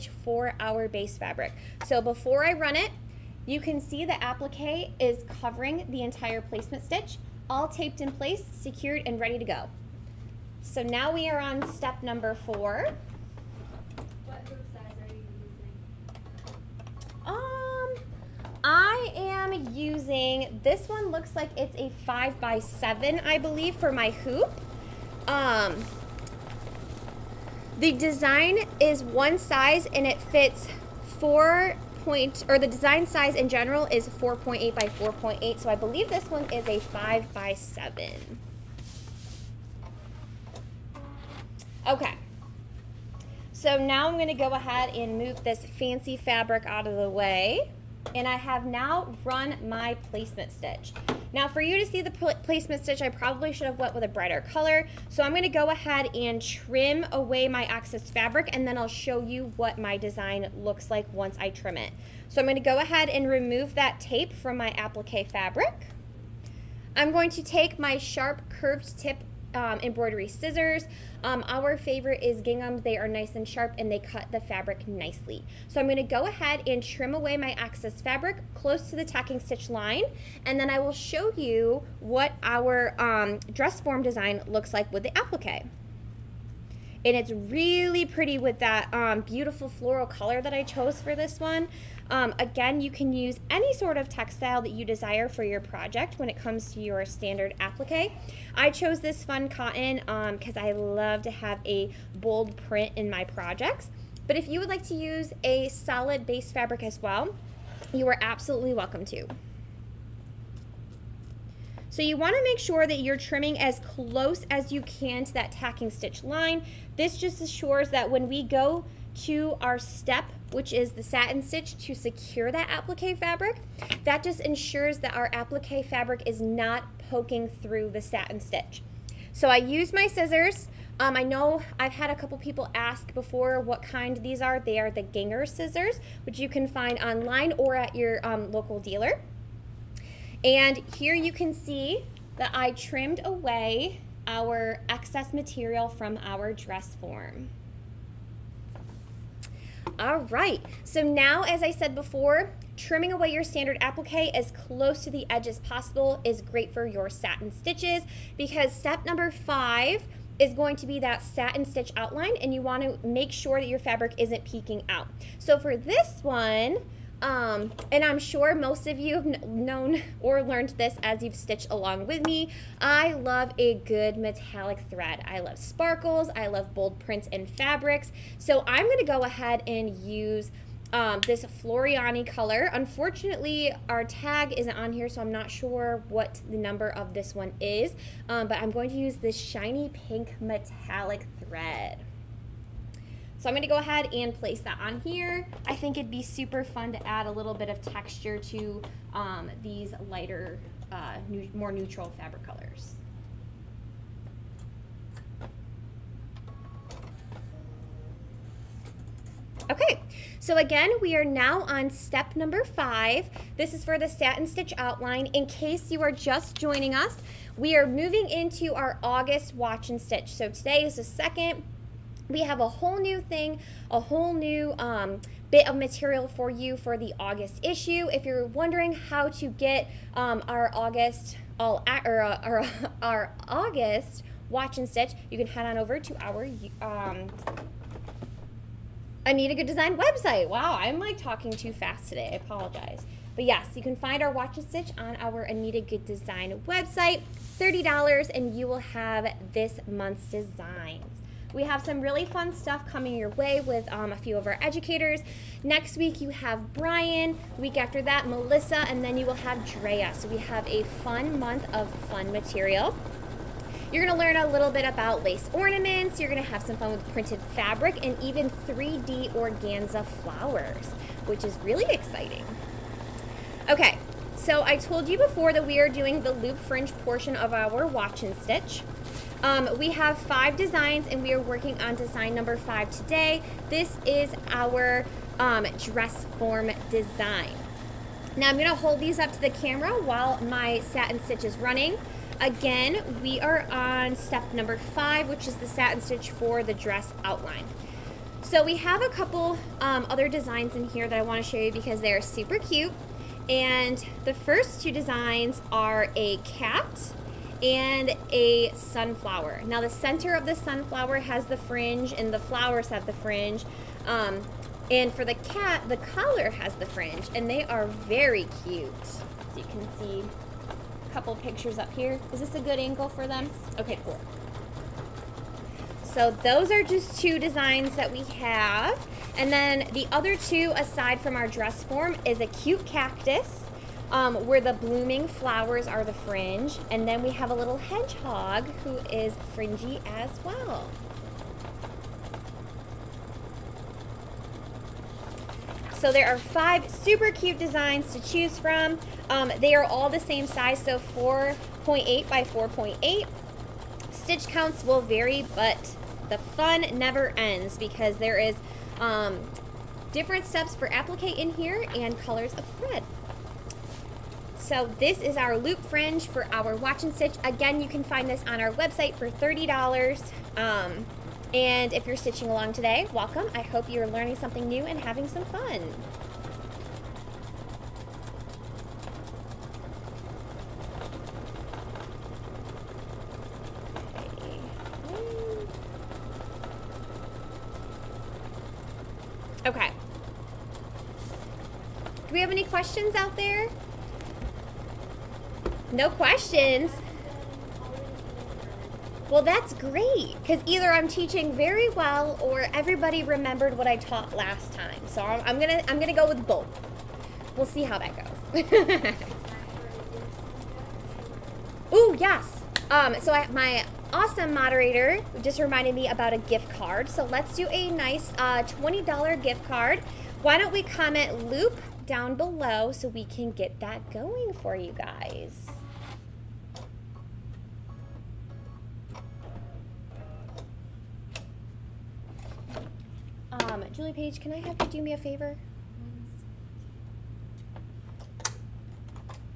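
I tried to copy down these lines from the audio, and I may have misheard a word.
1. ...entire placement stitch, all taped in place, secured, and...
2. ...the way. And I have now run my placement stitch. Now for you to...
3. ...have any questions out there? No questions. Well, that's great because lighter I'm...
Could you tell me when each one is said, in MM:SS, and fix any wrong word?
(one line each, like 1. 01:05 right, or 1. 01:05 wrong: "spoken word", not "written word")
1. 00:06 right
2. 00:46 right
3. 06:32 wrong: "either", not "lighter".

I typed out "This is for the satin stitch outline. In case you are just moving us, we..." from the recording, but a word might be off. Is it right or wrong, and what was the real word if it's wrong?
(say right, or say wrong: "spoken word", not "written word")
wrong: "joining", not "moving".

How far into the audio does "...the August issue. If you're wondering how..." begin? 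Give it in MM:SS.
03:46.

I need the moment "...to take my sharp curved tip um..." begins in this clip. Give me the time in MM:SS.
01:07.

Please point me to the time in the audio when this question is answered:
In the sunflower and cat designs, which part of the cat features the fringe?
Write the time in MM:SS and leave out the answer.
05:15.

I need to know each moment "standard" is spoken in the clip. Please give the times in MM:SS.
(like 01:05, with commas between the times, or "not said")
01:37, 02:33.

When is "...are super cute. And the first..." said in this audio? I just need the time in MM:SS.
05:02.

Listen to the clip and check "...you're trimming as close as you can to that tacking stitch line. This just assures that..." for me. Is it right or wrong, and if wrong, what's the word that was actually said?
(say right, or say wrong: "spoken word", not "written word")
right.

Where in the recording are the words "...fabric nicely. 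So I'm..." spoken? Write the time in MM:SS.
01:14.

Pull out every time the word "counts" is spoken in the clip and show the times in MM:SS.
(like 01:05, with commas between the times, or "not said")
05:54.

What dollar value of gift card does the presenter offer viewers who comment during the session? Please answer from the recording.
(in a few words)
$20.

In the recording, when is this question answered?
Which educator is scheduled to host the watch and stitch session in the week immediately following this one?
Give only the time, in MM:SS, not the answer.
04:16.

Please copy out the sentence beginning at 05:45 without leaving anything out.
So there are five super cute designs to choose from.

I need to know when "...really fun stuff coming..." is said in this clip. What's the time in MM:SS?
04:12.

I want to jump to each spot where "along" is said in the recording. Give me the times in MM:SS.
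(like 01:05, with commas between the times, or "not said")
02:51, 06:12.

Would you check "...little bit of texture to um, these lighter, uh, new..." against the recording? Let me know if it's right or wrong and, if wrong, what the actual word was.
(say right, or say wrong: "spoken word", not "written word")
right.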